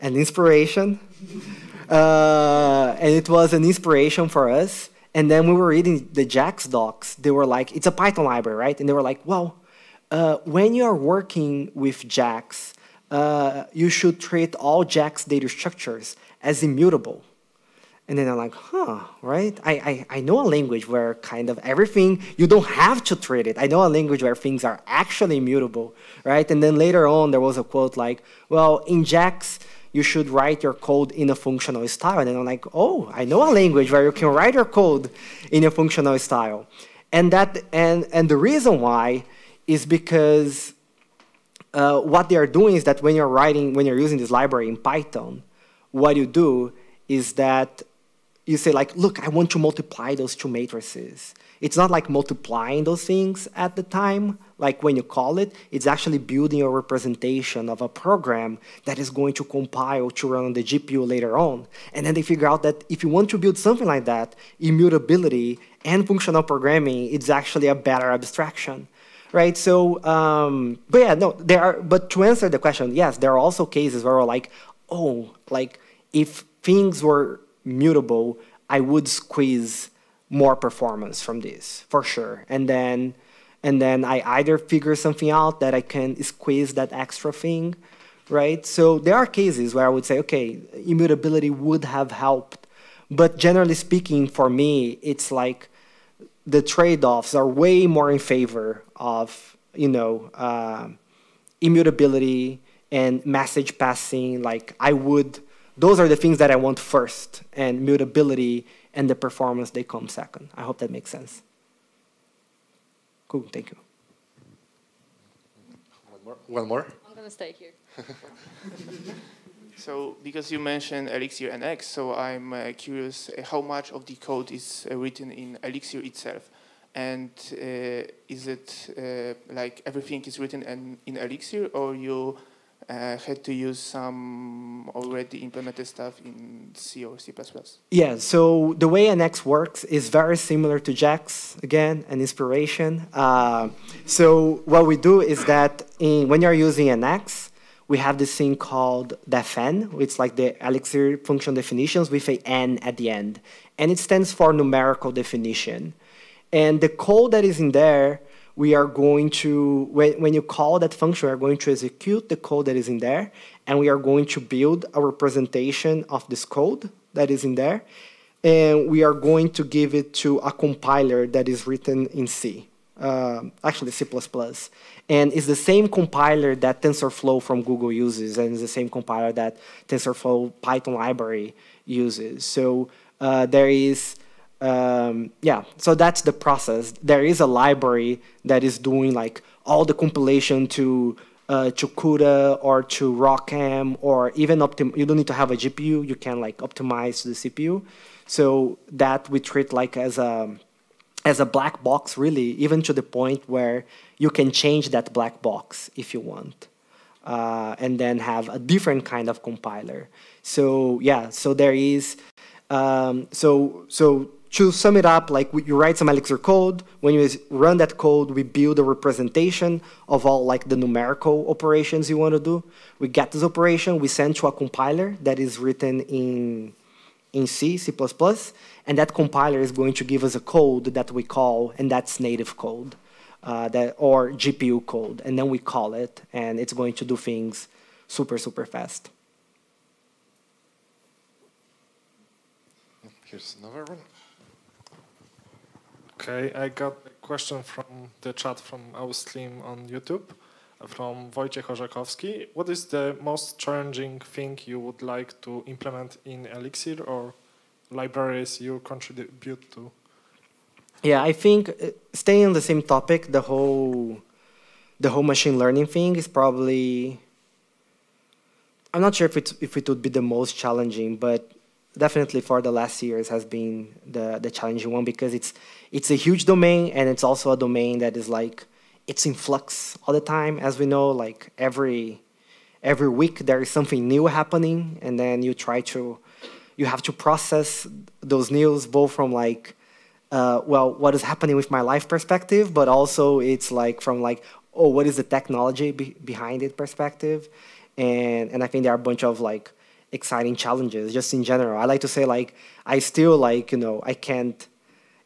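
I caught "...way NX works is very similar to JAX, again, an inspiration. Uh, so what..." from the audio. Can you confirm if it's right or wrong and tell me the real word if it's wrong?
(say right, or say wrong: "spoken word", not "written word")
right.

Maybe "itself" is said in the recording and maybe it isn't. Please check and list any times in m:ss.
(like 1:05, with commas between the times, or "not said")
2:06.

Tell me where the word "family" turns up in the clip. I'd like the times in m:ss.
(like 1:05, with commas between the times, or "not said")
not said.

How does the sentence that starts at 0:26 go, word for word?
And then later on, there was a quote like, well, in JAX, you should write your code in a functional style.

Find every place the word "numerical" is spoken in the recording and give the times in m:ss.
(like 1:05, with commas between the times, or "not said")
2:34, 3:40.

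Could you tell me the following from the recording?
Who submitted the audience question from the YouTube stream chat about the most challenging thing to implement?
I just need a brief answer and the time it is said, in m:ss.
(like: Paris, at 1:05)
Wojciech Orzechowski, at 4:11.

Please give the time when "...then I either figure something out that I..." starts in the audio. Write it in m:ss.
1:23.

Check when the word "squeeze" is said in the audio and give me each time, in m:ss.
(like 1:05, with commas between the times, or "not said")
1:19, 1:26.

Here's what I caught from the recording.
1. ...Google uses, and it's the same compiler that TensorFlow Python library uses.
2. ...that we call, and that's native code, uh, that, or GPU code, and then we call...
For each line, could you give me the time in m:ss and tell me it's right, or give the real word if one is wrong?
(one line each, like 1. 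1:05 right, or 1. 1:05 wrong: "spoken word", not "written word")
1. 2:57 right
2. 3:50 right.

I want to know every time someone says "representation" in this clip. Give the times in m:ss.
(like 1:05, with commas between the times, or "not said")
0:56, 2:45, 3:38.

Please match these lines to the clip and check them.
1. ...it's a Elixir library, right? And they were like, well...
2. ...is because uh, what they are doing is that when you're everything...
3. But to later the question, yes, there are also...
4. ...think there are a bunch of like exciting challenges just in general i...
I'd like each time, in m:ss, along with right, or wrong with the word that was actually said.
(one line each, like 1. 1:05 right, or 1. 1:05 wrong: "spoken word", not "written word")
1. 0:07 wrong: "Python", not "Elixir"
2. 0:39 wrong: "writing", not "everything"
3. 1:11 wrong: "answer", not "later"
4. 4:58 right.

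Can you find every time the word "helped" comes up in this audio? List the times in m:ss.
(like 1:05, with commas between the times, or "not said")
1:32.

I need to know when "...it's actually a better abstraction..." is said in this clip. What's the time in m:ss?
1:07.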